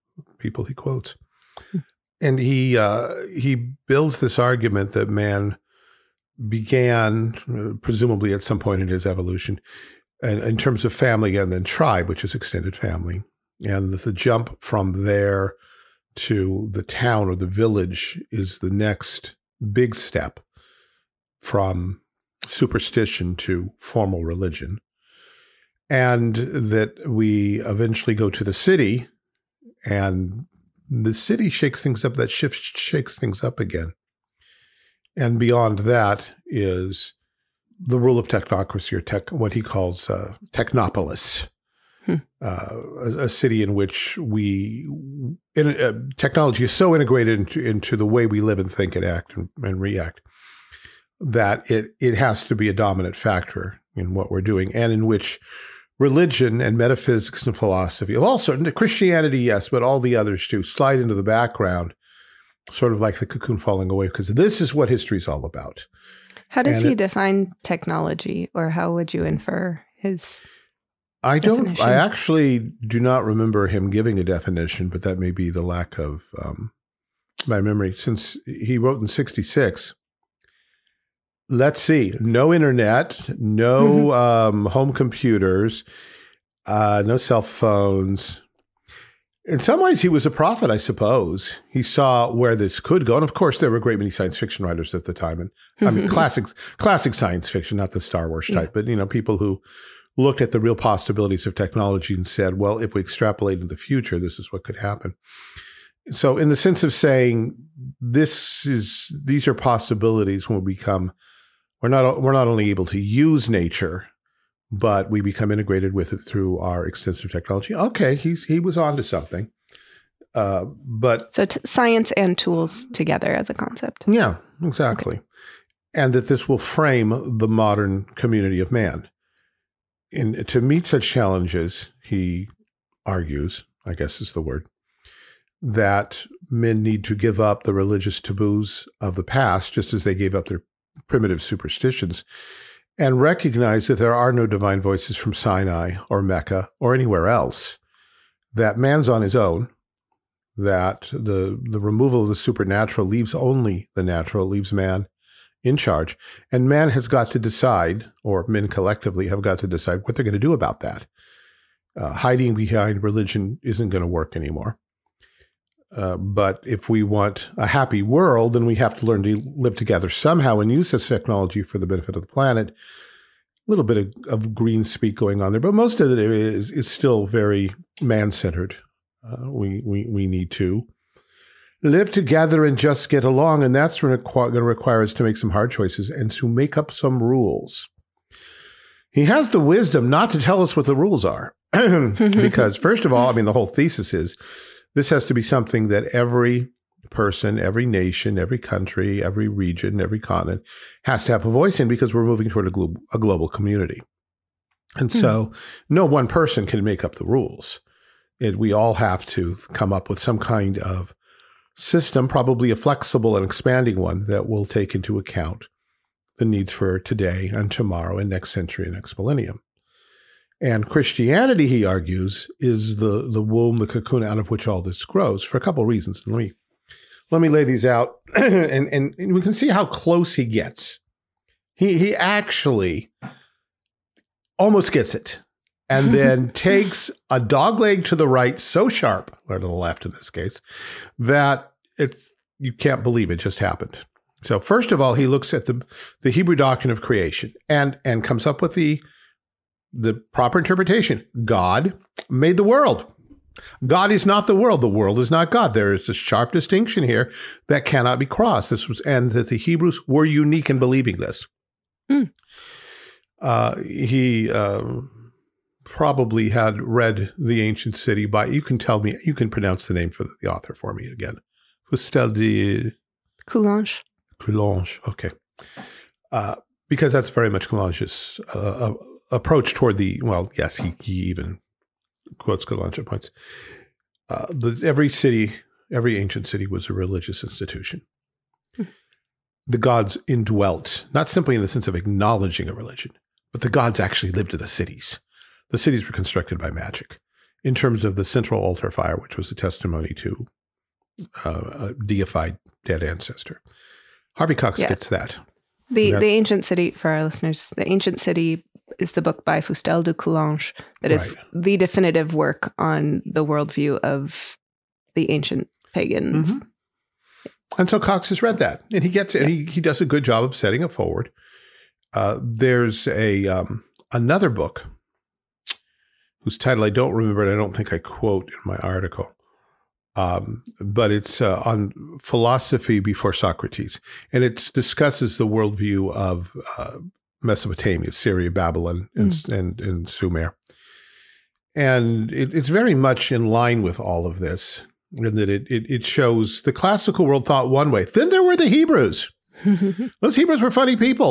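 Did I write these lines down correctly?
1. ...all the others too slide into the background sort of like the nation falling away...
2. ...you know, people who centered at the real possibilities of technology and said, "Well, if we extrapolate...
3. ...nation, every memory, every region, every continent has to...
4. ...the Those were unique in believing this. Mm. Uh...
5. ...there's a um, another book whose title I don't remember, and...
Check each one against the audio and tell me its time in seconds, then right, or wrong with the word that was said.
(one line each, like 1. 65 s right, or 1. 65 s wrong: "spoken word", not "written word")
1. 59 s wrong: "cocoon", not "nation"
2. 98 s wrong: "looked", not "centered"
3. 197 s wrong: "country", not "memory"
4. 259 s wrong: "Hebrews", not "Those"
5. 322 s right.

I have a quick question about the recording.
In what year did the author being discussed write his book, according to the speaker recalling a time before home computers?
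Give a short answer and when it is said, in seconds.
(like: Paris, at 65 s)
1966, at 79 s.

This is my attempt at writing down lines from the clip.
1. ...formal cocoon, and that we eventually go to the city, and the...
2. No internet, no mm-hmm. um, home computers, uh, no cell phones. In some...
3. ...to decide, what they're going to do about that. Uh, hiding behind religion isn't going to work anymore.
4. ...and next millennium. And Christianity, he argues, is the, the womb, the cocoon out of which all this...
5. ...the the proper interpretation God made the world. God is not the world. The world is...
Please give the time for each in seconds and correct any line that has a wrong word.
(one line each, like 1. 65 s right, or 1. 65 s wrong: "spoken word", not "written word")
1. 23 s wrong: "religion", not "cocoon"
2. 82 s right
3. 159 s right
4. 218 s right
5. 248 s right.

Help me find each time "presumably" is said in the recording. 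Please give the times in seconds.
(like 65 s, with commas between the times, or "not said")
7 s.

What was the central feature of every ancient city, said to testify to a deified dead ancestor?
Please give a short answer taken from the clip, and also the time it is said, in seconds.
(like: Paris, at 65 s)
The central altar fire, at 298 s.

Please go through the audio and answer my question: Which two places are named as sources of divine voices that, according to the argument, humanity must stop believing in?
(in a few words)
Sinai or Mecca.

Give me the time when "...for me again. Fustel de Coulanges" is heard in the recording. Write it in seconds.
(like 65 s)
270 s.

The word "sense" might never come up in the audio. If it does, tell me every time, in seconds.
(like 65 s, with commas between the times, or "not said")
106 s, 291 s.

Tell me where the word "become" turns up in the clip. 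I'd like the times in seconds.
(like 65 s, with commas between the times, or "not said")
110 s, 115 s.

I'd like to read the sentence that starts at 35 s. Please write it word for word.
And beyond that is the rule of technocracy, or tech, what he calls uh, technopolis.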